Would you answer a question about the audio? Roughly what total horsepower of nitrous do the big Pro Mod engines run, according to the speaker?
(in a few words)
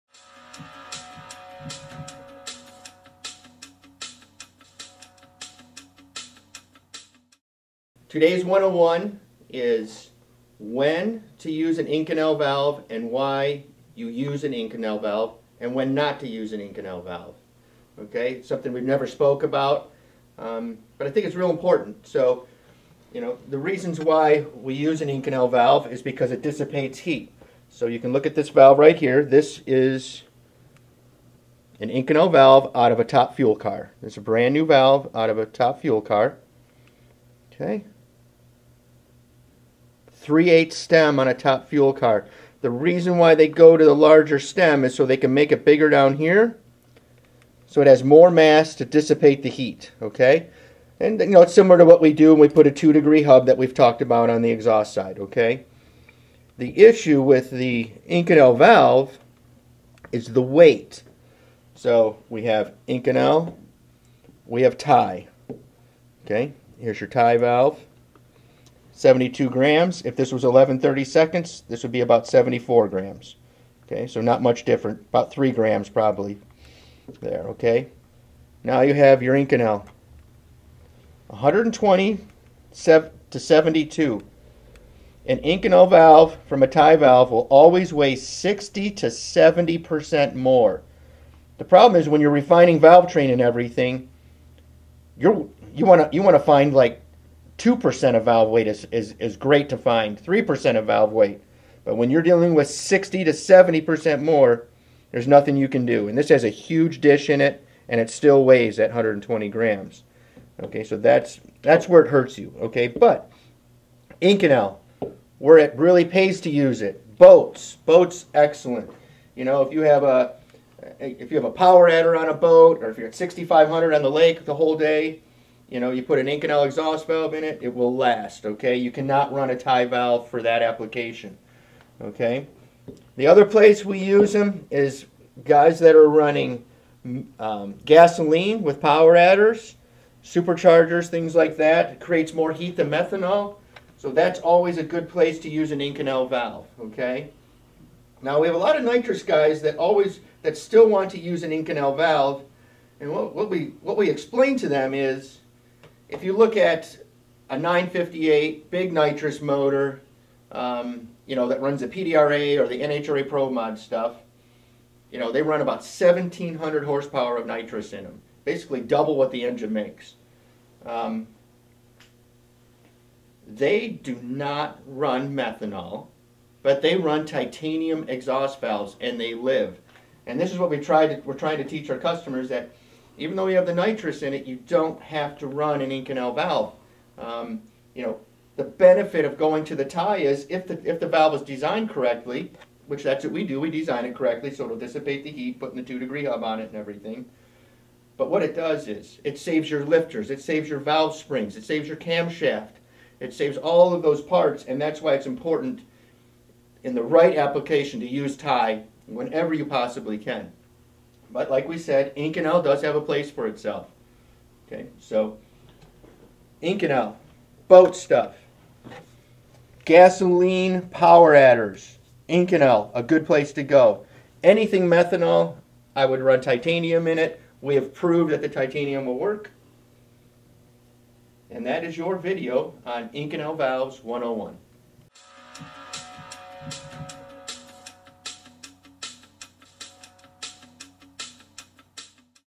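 1,700 horsepower.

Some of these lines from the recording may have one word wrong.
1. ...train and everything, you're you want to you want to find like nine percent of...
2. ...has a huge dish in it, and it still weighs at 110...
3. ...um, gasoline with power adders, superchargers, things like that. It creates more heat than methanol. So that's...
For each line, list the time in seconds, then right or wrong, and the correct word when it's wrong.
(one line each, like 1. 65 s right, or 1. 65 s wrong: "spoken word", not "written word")
1. 93 s wrong: "two", not "nine"
2. 106 s wrong: "120", not "110"
3. 137 s right.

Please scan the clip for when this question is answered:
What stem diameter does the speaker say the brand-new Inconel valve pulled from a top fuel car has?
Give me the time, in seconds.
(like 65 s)
40 s.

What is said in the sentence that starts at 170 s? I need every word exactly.
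Um, they do not run methanol but they run titanium exhaust valves and they live.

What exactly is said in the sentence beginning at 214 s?
Okay, so Inconel, boat stuff, gasoline power adders, Inconel, a good place to go.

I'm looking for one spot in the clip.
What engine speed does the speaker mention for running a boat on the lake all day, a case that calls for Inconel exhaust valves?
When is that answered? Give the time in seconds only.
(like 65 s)
123 s.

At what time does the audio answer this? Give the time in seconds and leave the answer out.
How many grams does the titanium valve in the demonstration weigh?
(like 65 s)
68 s.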